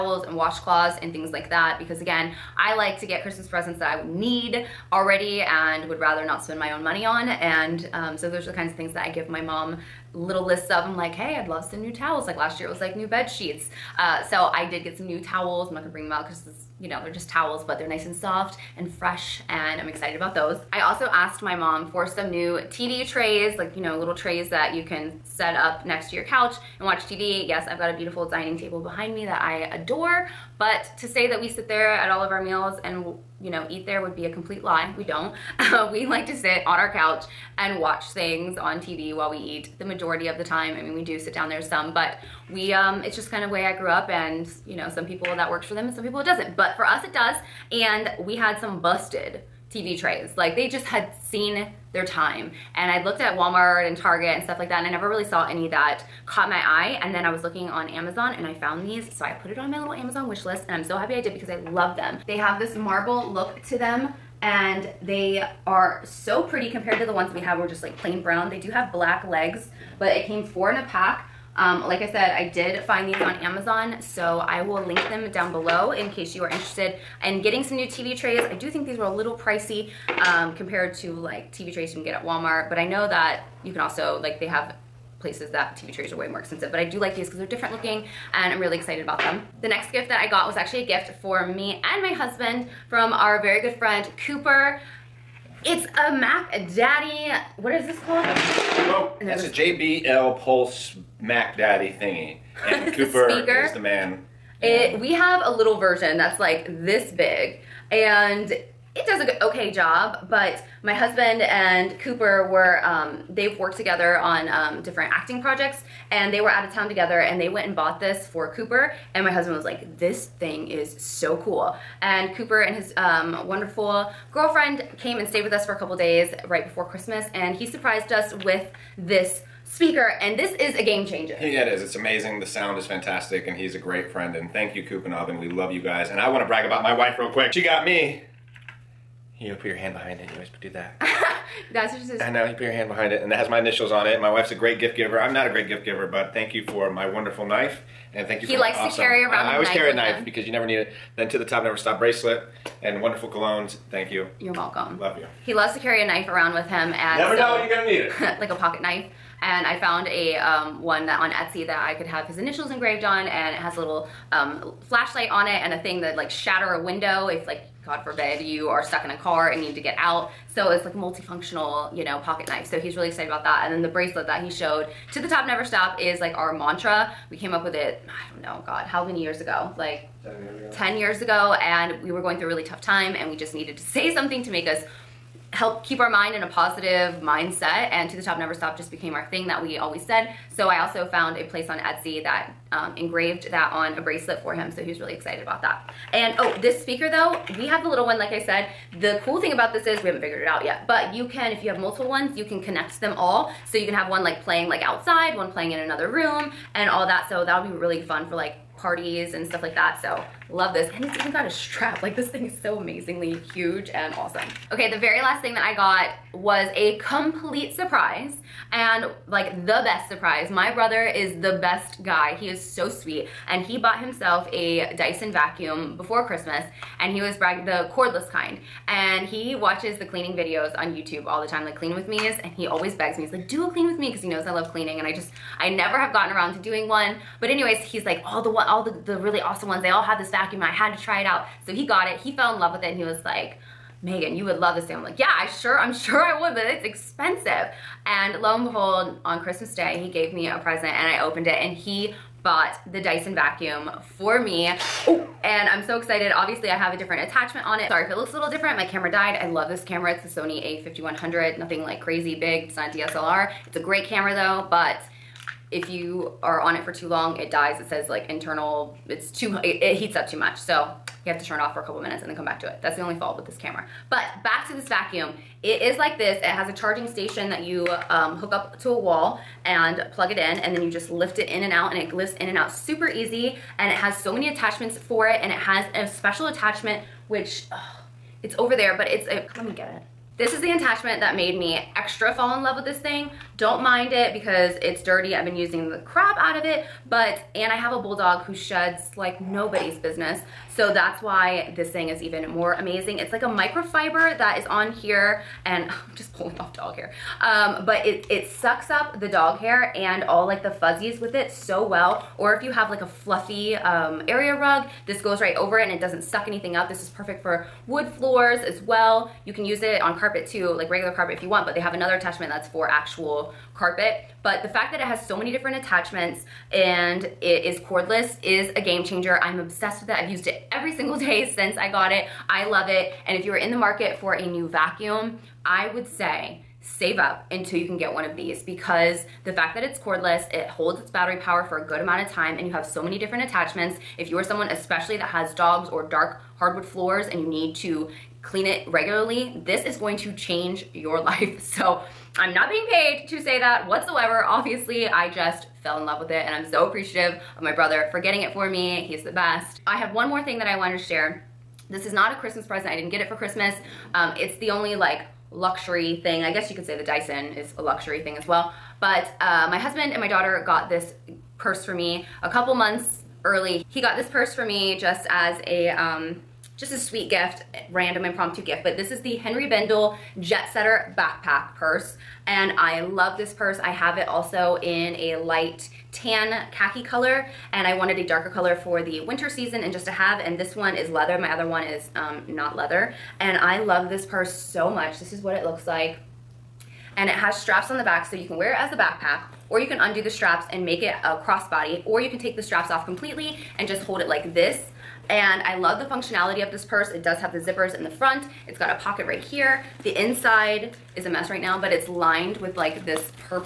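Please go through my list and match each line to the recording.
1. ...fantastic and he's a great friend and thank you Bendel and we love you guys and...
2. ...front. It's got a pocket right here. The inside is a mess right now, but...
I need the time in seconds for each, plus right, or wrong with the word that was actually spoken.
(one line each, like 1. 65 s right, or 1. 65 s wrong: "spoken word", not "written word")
1. 132 s wrong: "Kupanov", not "Bendel"
2. 408 s right.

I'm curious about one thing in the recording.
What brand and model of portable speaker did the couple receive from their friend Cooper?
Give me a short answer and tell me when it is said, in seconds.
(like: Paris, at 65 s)
JBL Pulse, at 99 s.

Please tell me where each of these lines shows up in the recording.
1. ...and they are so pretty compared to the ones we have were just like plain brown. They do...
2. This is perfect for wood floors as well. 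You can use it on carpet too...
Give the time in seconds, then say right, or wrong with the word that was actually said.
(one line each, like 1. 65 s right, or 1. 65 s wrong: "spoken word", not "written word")
1. 64 s right
2. 316 s right.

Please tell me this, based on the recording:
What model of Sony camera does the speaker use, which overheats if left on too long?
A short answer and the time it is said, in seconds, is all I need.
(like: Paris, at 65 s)
Sony a5100, at 260 s.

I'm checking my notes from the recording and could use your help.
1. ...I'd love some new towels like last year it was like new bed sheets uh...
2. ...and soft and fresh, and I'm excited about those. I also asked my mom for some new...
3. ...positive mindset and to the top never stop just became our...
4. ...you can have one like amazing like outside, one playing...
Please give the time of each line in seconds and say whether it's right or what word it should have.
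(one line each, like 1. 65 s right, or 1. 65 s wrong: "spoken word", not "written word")
1. 11 s right
2. 18 s right
3. 186 s right
4. 203 s wrong: "playing", not "amazing".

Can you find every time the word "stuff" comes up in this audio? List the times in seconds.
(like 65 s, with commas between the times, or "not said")
54 s, 209 s.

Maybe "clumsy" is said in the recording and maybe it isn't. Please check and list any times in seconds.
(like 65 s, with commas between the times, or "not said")
not said.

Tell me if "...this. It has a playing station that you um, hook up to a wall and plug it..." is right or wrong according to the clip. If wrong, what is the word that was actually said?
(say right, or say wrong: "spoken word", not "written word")
wrong: "charging", not "playing".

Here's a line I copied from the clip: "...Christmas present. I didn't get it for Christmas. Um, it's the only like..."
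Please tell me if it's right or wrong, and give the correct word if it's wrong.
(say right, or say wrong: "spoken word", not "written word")
right.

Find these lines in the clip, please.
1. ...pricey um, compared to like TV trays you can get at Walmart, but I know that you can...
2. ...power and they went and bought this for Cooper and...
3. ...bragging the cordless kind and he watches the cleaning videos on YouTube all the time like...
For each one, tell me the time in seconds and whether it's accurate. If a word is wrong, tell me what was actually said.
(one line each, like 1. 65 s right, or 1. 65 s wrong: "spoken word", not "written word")
1. 79 s right
2. 116 s wrong: "together", not "power"
3. 227 s right.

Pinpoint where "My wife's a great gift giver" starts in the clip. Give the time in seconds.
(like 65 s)
144 s.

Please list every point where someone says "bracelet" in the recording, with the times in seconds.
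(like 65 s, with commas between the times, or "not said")
151 s, 173 s, 193 s.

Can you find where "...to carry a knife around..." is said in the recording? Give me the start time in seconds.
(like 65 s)
155 s.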